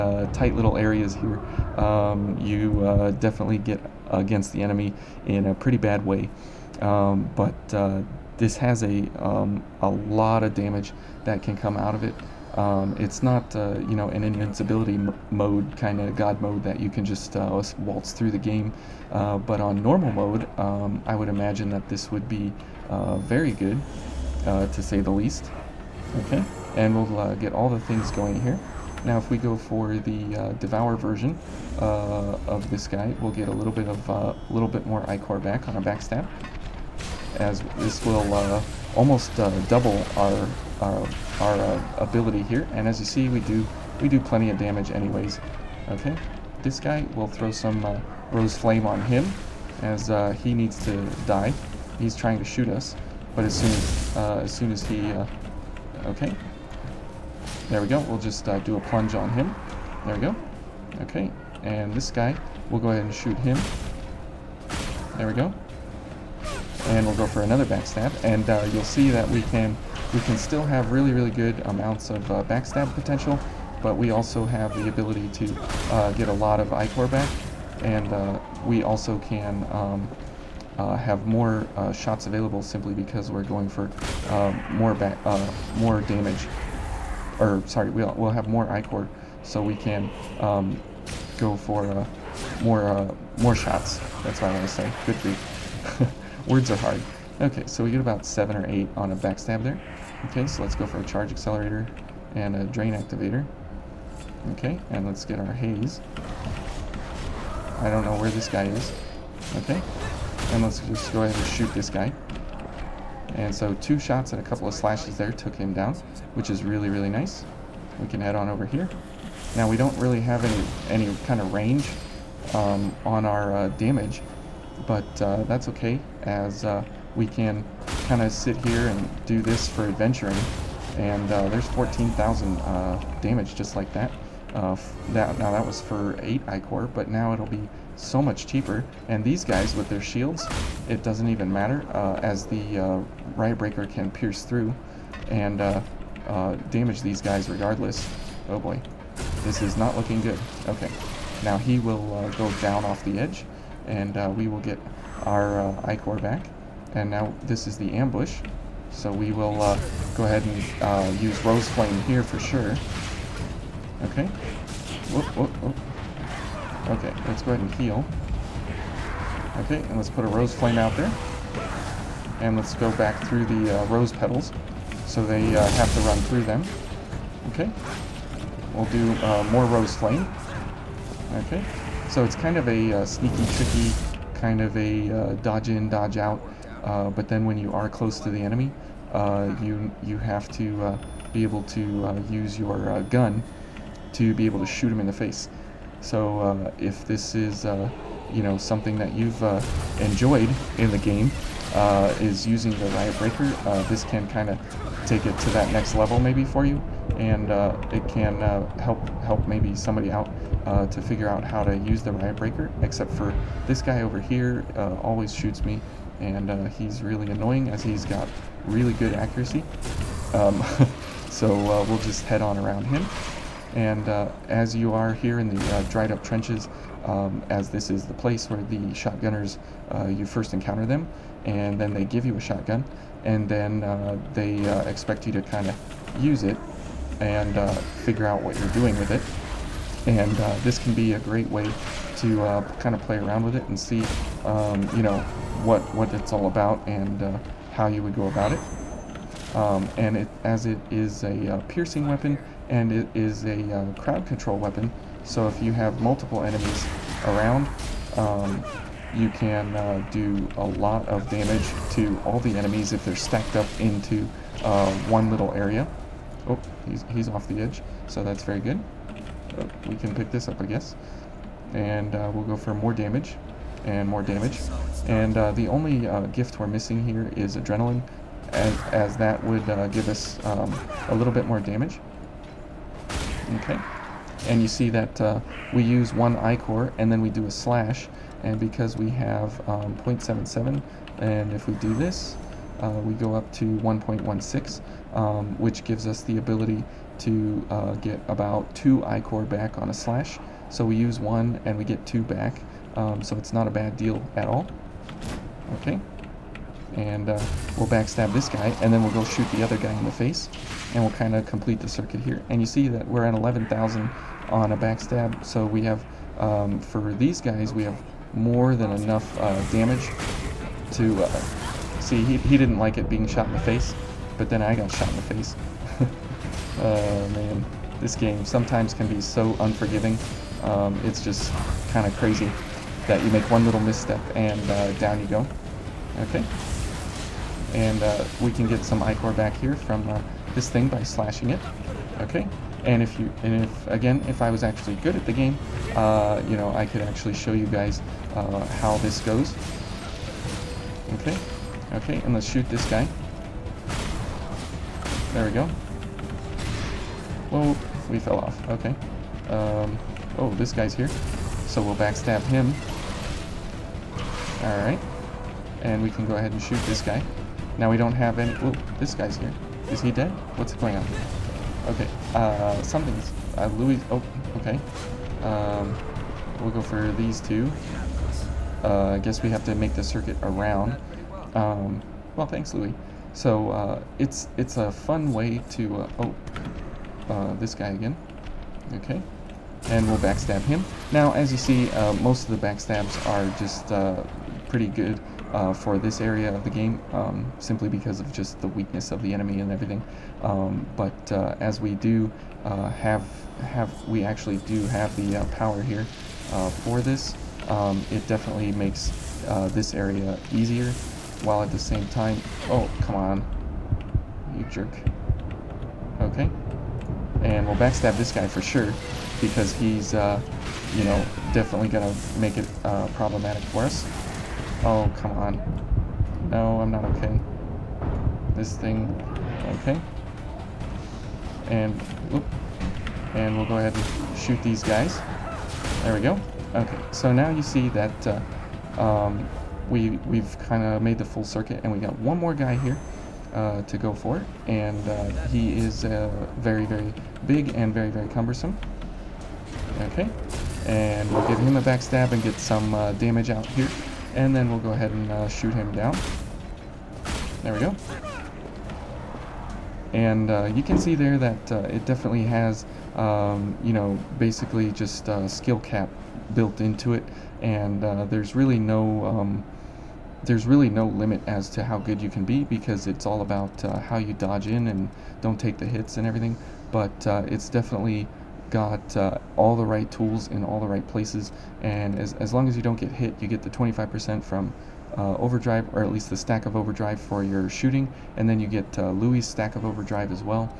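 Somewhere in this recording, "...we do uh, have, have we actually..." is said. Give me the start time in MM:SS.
06:41.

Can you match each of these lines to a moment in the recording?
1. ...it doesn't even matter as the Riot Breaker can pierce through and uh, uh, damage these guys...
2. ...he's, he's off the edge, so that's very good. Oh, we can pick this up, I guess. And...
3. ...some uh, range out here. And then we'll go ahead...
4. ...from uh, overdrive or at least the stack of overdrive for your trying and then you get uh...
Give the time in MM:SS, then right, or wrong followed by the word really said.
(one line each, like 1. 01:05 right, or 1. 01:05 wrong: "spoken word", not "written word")
1. 02:20 right
2. 04:26 right
3. 07:32 wrong: "damage", not "range"
4. 08:04 wrong: "shooting", not "trying".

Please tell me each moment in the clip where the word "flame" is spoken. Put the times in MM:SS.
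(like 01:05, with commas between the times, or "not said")
00:48, 02:41, 02:50, 02:59.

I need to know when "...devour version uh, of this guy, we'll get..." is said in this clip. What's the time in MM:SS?
00:30.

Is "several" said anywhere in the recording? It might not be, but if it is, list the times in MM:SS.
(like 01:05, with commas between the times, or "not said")
not said.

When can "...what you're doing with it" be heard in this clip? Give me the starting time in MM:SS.
03:58.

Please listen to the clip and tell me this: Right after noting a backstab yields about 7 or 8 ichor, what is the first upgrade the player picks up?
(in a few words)
charge accelerator.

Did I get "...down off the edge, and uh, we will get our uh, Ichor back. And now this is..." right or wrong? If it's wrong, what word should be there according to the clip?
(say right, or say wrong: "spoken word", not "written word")
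right.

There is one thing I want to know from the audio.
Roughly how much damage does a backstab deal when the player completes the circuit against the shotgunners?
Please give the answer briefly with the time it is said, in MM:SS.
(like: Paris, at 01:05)
11,000, at 05:13.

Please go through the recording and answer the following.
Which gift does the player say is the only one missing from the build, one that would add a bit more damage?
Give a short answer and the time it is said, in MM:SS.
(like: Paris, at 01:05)
Adrenaline, at 04:37.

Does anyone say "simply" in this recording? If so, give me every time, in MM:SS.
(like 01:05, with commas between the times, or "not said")
01:22, 06:37.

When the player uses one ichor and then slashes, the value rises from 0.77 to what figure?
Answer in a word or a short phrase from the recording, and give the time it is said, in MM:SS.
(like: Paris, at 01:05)
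1.16, at 04:53.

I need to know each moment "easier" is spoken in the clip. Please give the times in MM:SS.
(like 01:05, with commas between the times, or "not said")
06:50.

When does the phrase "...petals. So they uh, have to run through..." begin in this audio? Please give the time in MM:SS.
02:54.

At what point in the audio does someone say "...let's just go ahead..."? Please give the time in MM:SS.
01:50.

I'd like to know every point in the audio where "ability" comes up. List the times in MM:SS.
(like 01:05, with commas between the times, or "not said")
00:41, 01:14, 04:56.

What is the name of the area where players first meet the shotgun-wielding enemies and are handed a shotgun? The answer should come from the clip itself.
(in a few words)
dried up trenches.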